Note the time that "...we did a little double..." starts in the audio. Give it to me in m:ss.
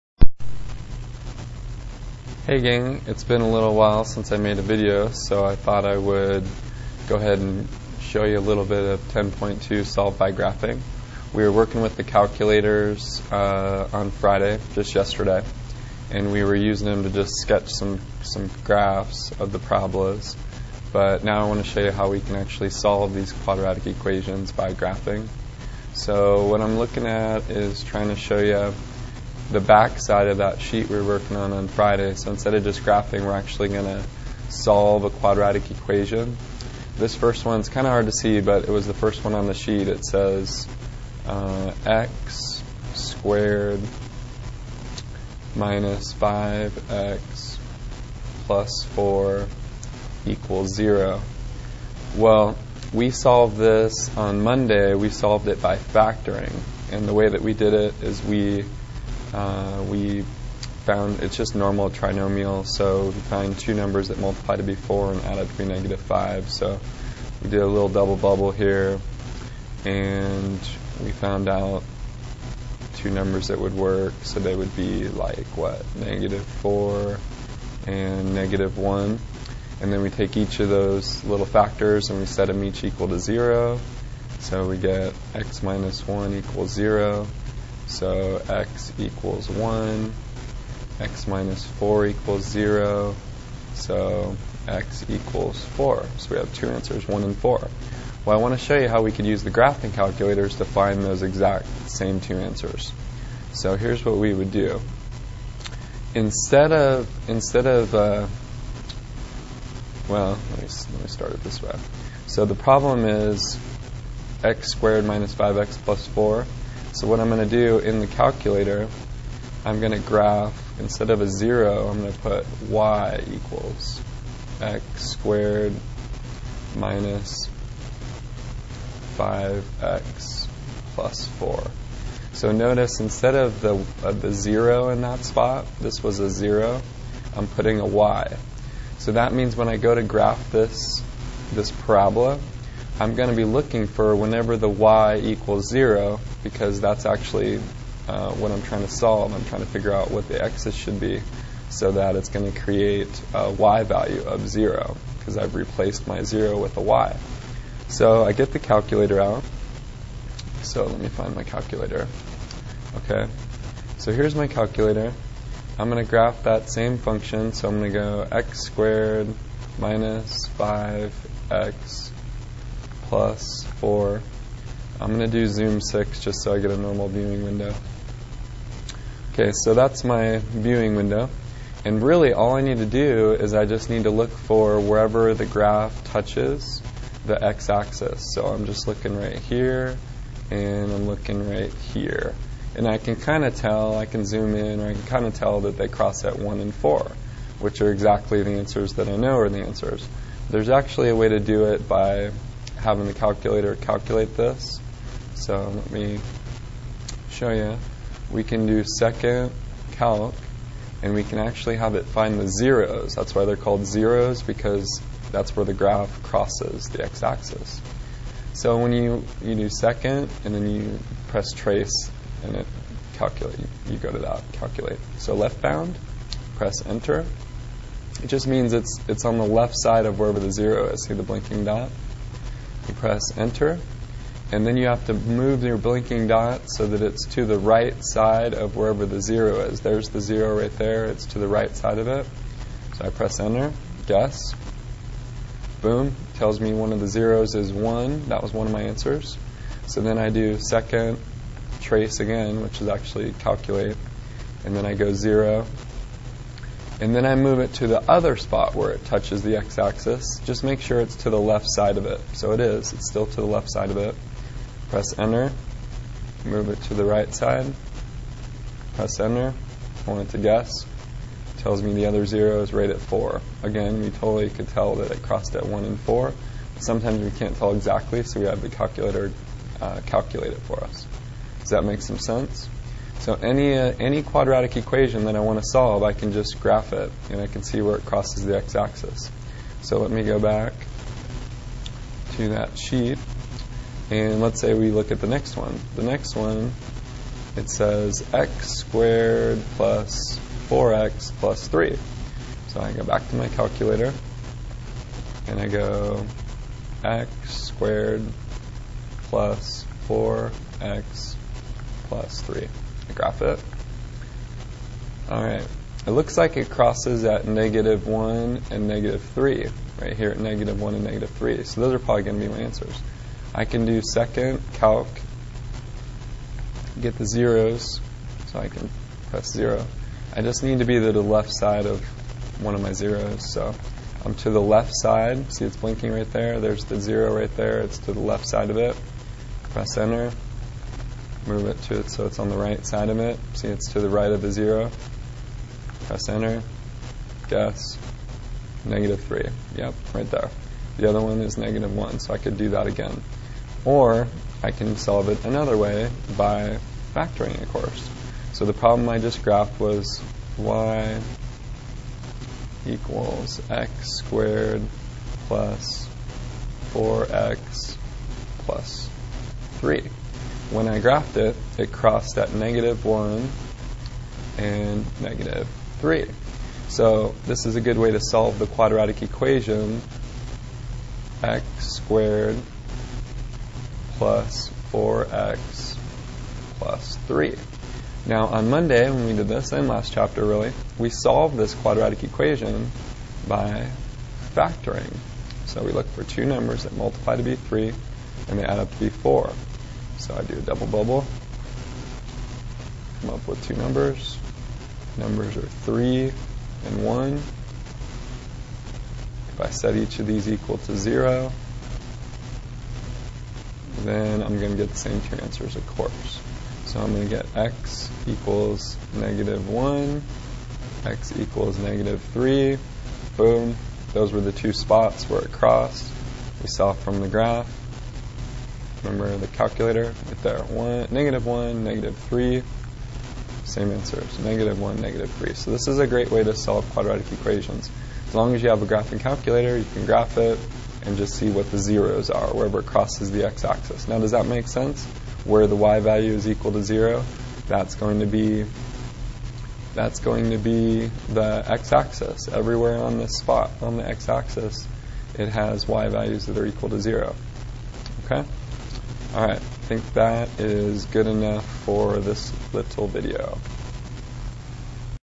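1:07.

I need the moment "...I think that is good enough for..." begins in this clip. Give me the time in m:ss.
7:39.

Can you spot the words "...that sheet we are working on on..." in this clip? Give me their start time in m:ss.
0:30.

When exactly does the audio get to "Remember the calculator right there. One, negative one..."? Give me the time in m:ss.
7:09.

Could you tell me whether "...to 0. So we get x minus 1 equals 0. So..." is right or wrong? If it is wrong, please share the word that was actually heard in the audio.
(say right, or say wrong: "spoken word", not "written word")
right.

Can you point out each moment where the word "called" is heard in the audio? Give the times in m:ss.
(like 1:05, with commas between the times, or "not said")
3:33.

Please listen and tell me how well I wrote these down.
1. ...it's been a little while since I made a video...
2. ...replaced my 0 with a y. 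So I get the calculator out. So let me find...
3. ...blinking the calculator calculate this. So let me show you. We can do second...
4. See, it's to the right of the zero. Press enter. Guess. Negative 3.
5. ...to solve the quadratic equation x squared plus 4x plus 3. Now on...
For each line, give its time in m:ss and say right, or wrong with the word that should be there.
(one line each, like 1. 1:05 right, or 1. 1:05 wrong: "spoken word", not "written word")
1. 0:03 right
2. 2:35 right
3. 3:22 wrong: "having", not "blinking"
4. 5:43 right
5. 6:18 right.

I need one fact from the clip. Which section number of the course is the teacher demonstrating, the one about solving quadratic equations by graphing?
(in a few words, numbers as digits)
10.2.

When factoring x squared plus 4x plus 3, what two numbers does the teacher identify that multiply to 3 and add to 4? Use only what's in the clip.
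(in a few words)
3 and 1.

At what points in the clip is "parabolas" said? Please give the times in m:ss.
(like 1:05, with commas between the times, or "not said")
0:19, 2:21.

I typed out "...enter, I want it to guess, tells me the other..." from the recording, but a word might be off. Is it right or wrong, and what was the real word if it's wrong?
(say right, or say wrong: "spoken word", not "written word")
right.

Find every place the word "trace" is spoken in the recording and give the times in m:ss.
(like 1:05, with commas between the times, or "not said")
3:41, 4:11.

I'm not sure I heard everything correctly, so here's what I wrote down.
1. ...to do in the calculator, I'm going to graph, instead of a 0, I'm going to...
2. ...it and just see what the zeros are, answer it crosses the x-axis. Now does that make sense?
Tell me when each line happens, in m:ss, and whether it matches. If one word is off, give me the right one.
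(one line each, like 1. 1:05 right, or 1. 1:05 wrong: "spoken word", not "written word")
1. 1:57 right
2. 7:20 wrong: "wherever", not "answer".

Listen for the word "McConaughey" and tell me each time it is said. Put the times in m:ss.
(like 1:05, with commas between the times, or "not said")
not said.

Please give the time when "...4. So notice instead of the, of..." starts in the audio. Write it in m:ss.
2:11.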